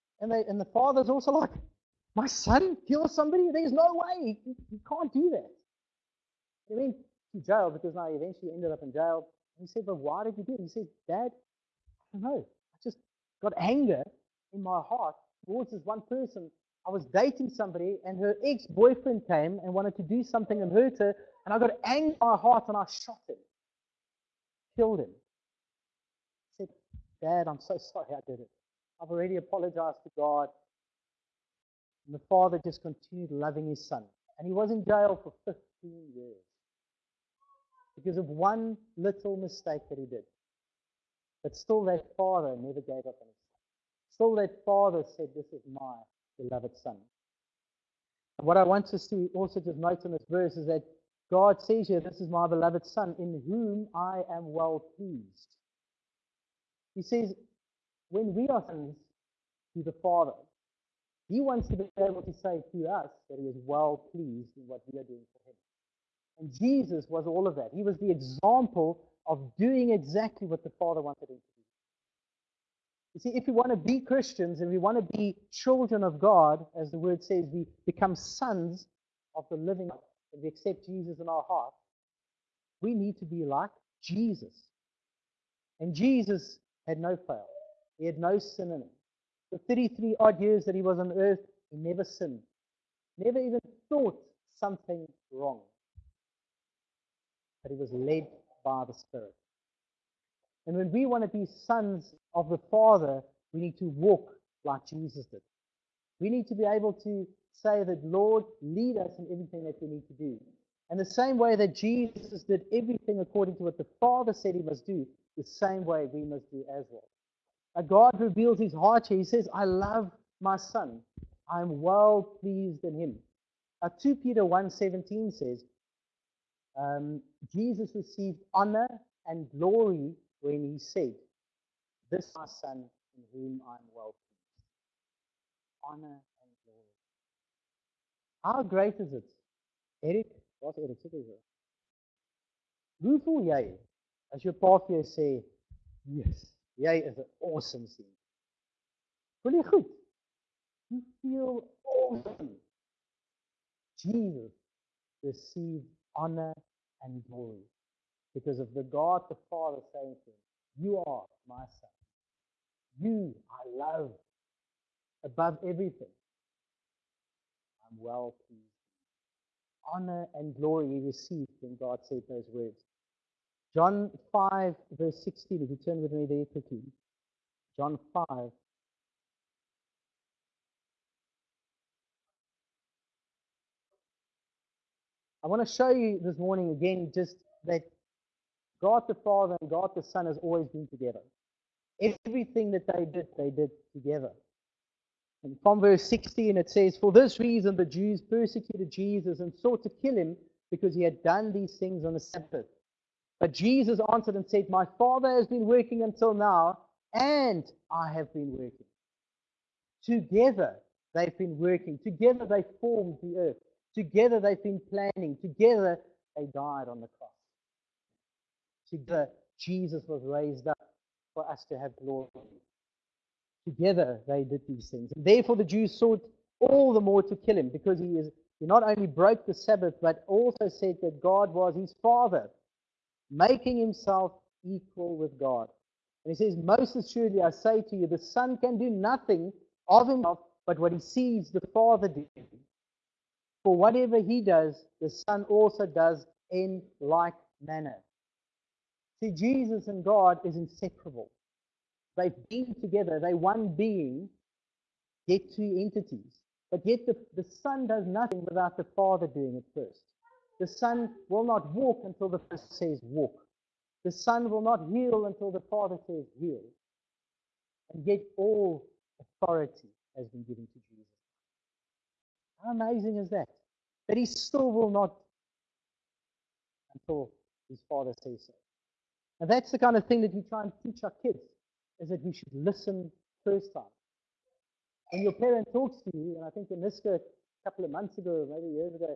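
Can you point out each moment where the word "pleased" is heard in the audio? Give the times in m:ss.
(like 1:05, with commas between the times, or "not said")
0:54, 1:04, 2:02, 2:15, 2:48.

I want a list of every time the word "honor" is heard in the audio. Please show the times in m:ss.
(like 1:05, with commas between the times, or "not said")
2:08, 2:16, 2:36, 2:49.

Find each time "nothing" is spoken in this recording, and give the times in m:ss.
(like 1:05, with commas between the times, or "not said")
3:58, 4:18.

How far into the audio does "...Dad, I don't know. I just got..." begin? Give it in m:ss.
0:11.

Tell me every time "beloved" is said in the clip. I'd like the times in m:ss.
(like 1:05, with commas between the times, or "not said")
0:46, 0:52.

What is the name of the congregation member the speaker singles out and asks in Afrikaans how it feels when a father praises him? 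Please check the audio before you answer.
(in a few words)
Eric.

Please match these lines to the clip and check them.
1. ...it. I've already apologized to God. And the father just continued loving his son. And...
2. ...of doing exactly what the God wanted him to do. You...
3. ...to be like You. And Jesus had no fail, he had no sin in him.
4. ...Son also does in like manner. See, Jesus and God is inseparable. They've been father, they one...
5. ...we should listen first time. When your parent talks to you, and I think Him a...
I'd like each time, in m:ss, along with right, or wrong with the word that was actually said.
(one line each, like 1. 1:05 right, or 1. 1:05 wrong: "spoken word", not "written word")
1. 0:28 right
2. 1:09 wrong: "Father", not "God"
3. 1:23 wrong: "Jesus", not "You"
4. 4:05 wrong: "together", not "father"
5. 4:42 wrong: "Aniska", not "Him".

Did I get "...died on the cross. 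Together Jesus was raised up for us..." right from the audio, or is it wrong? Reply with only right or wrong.
right.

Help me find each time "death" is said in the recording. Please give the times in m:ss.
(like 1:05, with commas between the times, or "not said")
not said.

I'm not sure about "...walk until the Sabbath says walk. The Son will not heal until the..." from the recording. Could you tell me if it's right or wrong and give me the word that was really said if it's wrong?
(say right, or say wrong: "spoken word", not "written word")
wrong: "Father", not "Sabbath".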